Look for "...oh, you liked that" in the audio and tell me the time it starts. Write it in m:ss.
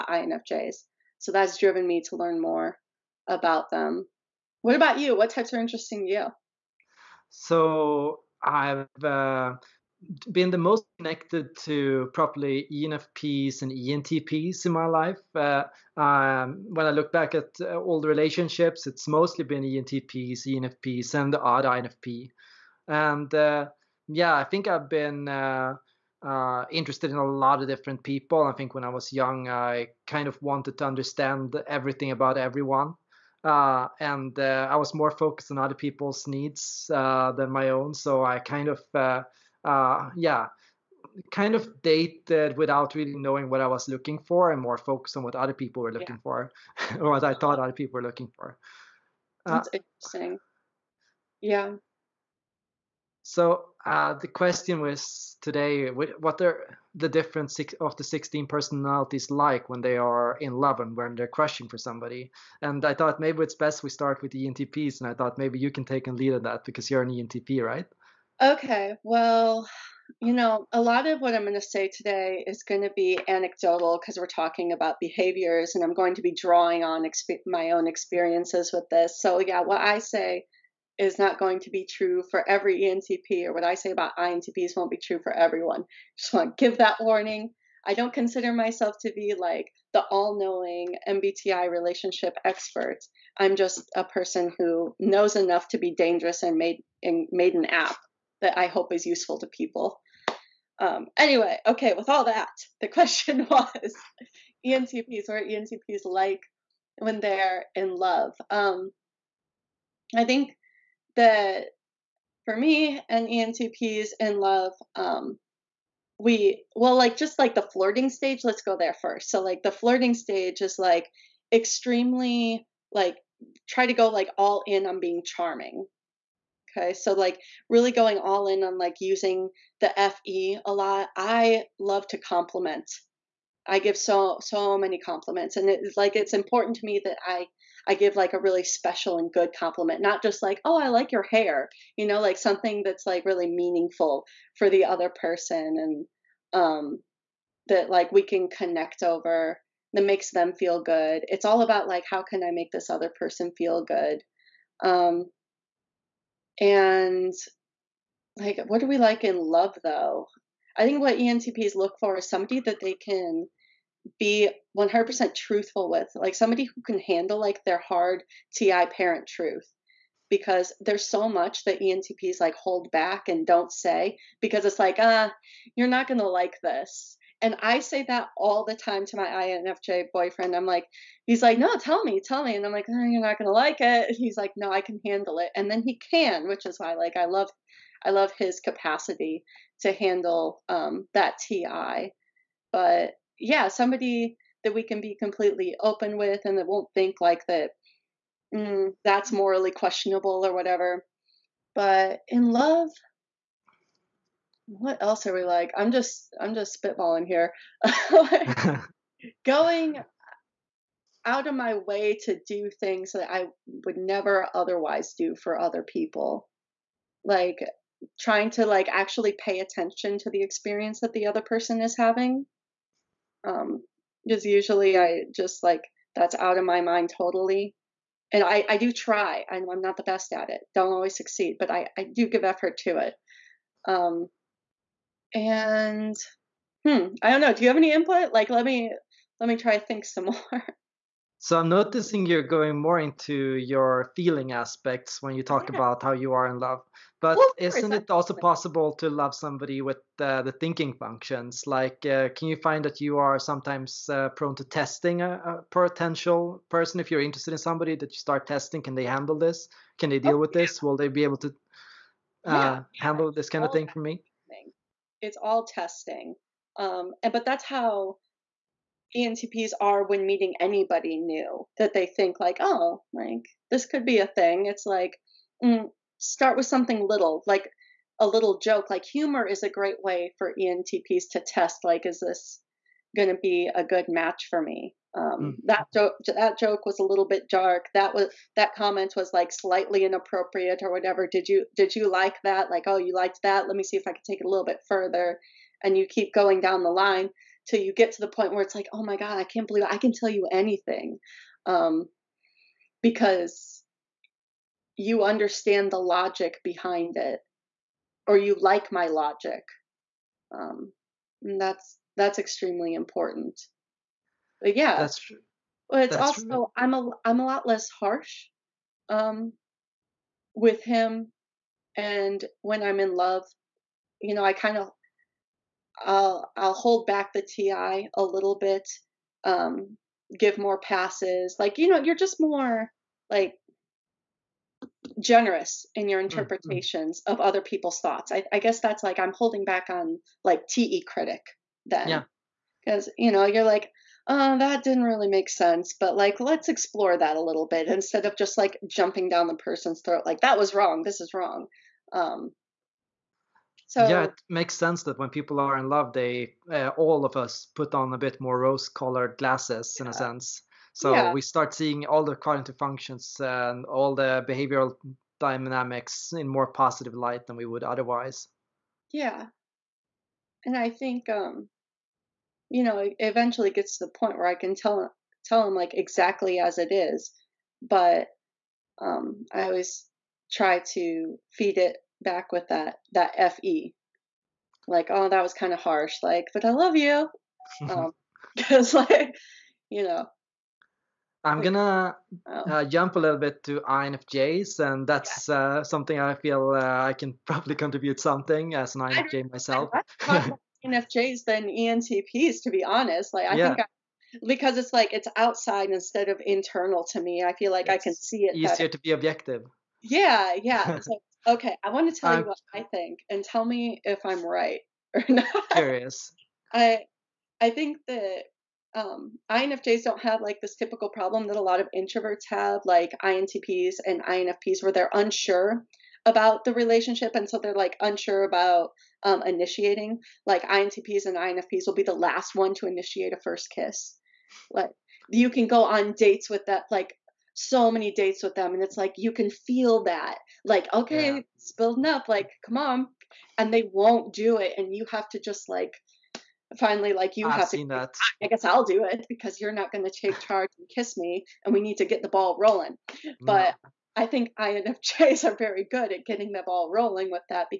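4:52.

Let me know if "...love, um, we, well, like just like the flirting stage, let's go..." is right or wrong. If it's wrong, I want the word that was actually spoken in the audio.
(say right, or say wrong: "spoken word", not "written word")
right.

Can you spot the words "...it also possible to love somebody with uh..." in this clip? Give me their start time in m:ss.
4:08.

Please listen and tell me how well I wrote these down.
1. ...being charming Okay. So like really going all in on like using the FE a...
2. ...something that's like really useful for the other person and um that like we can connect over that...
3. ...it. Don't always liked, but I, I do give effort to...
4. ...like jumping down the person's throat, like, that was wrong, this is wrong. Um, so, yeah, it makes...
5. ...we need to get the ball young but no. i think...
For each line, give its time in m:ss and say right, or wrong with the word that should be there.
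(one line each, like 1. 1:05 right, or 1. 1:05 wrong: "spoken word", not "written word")
1. 2:04 right
2. 2:22 wrong: "meaningful", not "useful"
3. 3:50 wrong: "succeed", not "liked"
4. 5:48 right
5. 7:31 wrong: "rolling", not "young".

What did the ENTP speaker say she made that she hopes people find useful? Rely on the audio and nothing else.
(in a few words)
An app.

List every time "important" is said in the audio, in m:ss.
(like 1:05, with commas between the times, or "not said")
2:16, 5:12.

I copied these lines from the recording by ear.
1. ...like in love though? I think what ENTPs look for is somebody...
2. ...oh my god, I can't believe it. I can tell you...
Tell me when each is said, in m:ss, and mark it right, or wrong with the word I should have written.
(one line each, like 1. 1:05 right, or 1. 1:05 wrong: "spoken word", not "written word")
1. 2:38 right
2. 4:58 right.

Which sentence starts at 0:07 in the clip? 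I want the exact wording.
So I've uh, been the most connected to probably ENFPs and ENTPs in my life.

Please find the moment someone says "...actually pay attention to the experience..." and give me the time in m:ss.
3:38.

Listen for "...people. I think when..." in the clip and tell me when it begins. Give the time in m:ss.
0:28.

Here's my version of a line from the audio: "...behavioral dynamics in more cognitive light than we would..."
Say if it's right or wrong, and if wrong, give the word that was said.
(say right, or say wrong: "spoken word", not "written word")
wrong: "positive", not "cognitive".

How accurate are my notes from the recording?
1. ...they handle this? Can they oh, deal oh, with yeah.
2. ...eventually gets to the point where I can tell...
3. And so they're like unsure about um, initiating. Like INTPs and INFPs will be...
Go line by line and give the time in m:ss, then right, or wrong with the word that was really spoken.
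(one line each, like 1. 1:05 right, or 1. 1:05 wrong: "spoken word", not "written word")
1. 4:18 right
2. 6:13 right
3. 7:07 right.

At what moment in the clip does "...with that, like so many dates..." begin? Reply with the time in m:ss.
7:16.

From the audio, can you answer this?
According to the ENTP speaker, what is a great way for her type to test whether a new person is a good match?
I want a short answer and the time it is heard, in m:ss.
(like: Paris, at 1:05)
Humor, at 4:39.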